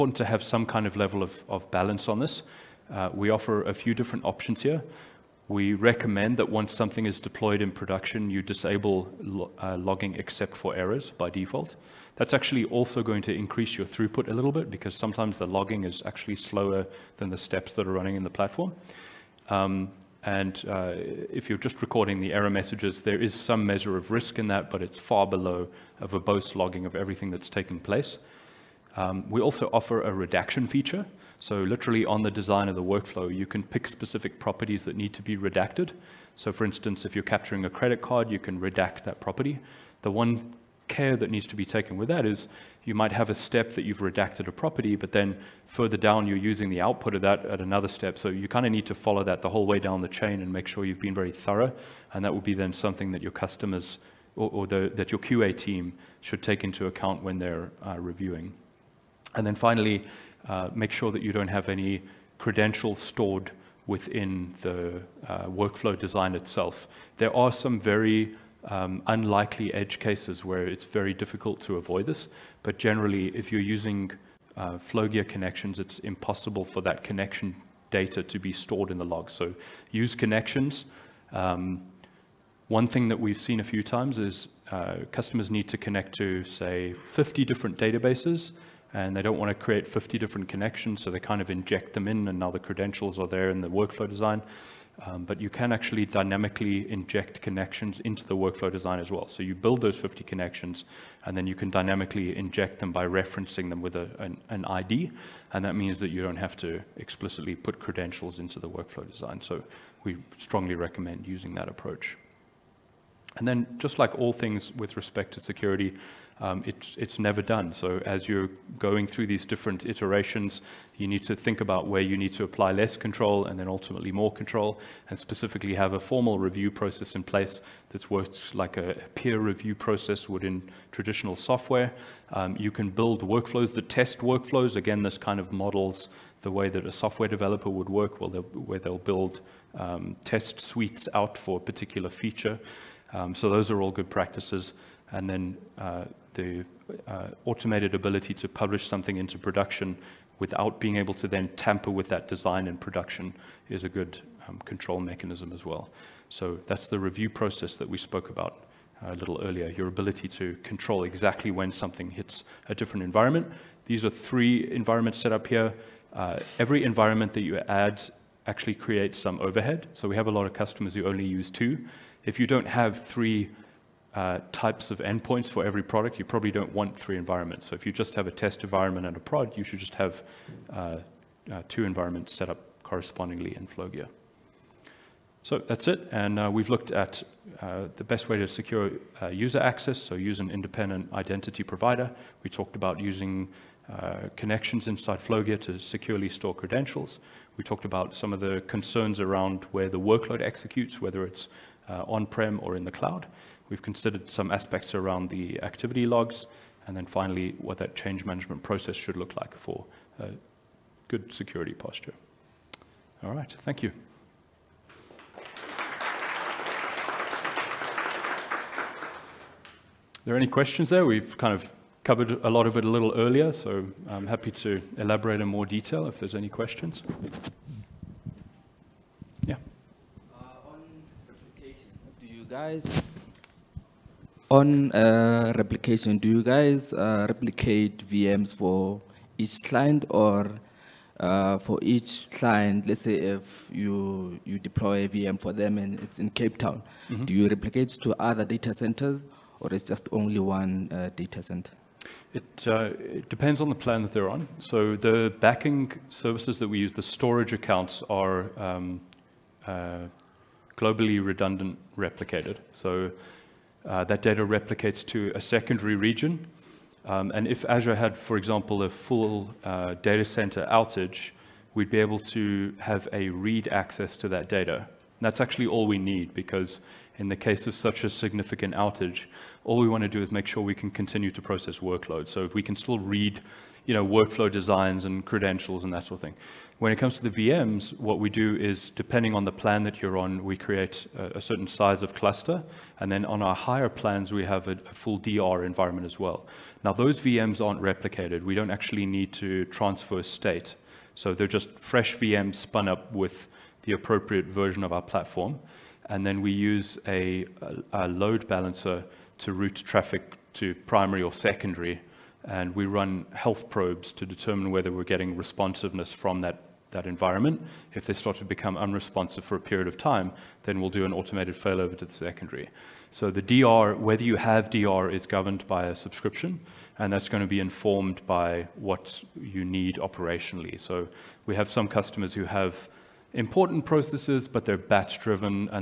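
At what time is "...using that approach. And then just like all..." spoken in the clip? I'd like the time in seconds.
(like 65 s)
111 s.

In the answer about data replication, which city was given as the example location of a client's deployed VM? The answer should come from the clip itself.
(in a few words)
Cape Town.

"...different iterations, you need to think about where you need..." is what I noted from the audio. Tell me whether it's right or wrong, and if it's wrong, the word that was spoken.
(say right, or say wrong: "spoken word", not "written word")
right.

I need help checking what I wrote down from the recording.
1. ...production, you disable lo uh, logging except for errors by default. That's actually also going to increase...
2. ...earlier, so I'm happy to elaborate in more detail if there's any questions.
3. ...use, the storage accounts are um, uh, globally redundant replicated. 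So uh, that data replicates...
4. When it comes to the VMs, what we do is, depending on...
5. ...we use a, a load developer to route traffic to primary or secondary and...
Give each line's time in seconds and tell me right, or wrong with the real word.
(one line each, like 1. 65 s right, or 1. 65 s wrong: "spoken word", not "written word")
1. 7 s right
2. 223 s right
3. 256 s right
4. 286 s right
5. 306 s wrong: "balancer", not "developer".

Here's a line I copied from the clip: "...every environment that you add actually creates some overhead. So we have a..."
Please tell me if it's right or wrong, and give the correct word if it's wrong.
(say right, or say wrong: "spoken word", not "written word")
right.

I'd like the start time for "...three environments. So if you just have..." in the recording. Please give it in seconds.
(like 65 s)
176 s.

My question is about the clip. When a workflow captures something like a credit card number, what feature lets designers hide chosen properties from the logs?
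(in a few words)
Redaction.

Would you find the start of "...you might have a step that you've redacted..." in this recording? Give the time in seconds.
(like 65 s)
42 s.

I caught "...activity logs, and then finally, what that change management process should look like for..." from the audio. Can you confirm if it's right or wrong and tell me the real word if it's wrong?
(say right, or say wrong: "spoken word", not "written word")
right.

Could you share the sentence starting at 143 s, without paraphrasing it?
Um, so those are all good practices.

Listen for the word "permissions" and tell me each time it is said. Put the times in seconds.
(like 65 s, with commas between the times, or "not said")
not said.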